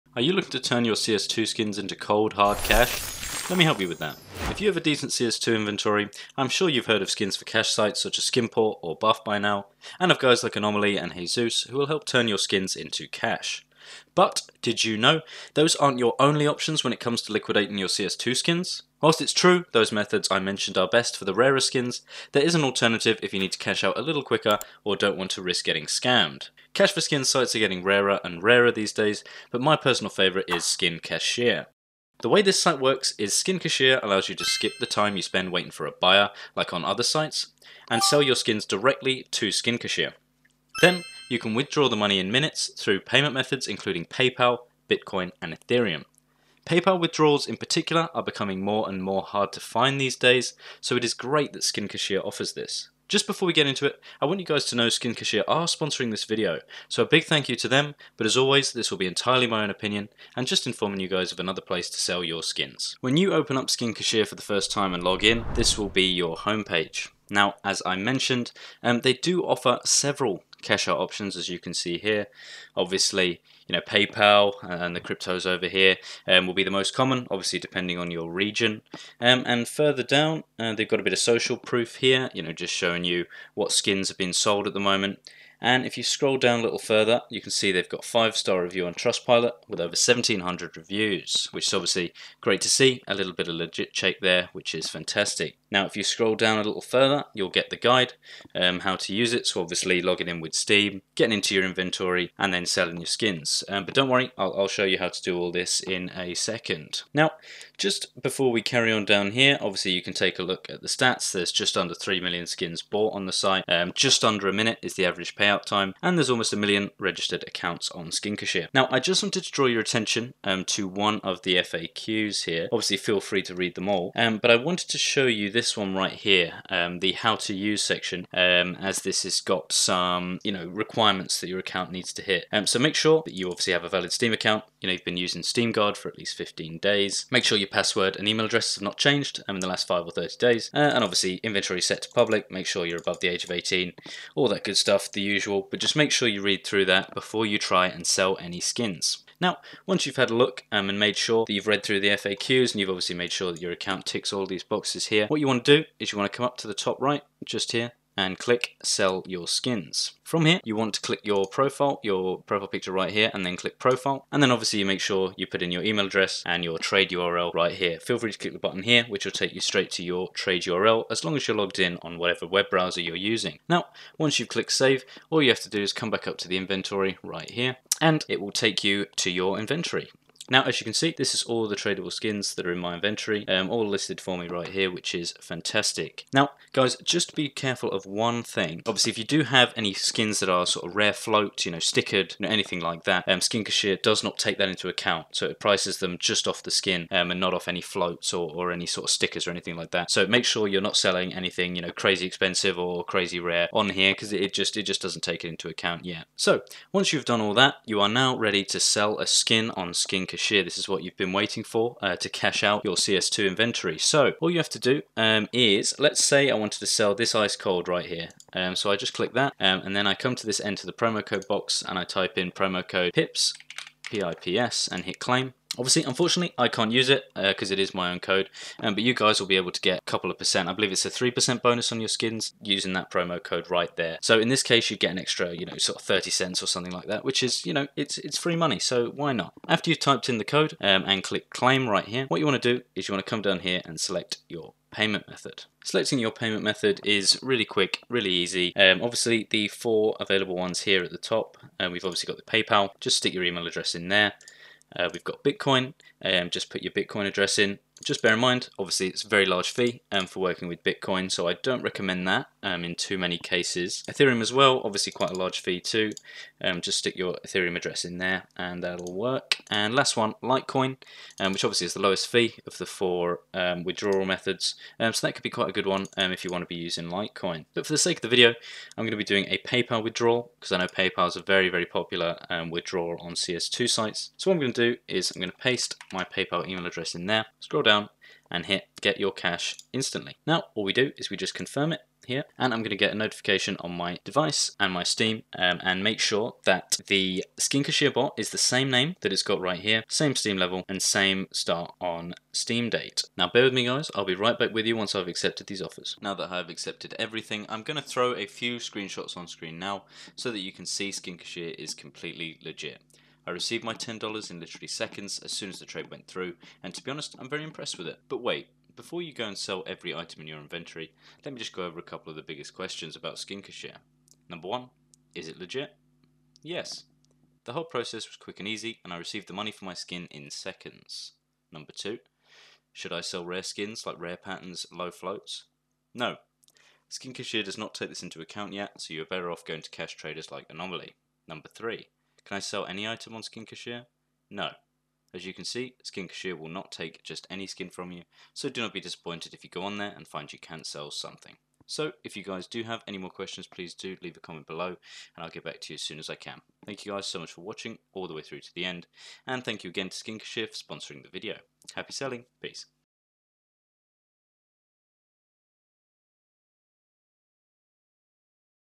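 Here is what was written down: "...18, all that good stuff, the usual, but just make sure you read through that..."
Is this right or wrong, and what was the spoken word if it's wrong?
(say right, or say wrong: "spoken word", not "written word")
right.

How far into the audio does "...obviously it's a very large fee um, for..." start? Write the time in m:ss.
4:18.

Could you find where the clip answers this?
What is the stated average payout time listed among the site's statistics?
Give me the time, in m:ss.
1:53.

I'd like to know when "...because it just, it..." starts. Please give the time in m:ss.
3:24.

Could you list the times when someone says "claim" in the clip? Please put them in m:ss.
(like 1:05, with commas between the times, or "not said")
3:45, 4:01.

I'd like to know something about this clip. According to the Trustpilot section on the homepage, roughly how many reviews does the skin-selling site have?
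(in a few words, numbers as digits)
over 1,700.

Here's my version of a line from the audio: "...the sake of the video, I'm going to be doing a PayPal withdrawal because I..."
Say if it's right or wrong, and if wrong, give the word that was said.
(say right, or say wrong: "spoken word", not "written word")
right.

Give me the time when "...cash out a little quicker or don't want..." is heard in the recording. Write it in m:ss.
0:23.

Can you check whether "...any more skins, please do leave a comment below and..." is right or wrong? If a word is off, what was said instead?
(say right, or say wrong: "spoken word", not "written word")
wrong: "questions", not "skins".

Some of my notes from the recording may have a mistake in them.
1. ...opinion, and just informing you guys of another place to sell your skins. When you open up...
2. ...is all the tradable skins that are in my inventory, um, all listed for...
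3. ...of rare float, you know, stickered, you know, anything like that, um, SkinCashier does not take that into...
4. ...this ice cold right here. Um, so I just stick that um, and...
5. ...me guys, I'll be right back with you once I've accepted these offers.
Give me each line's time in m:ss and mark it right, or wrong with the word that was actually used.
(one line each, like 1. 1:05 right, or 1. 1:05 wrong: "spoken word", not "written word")
1. 0:59 right
2. 3:01 right
3. 3:10 right
4. 3:37 wrong: "click", not "stick"
5. 5:03 right.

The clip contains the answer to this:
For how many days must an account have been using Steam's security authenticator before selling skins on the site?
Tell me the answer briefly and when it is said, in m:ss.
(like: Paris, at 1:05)
15 days, at 2:16.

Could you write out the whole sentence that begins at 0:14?
But did you know those aren't your only options when it comes to liquidating your CS2 skins?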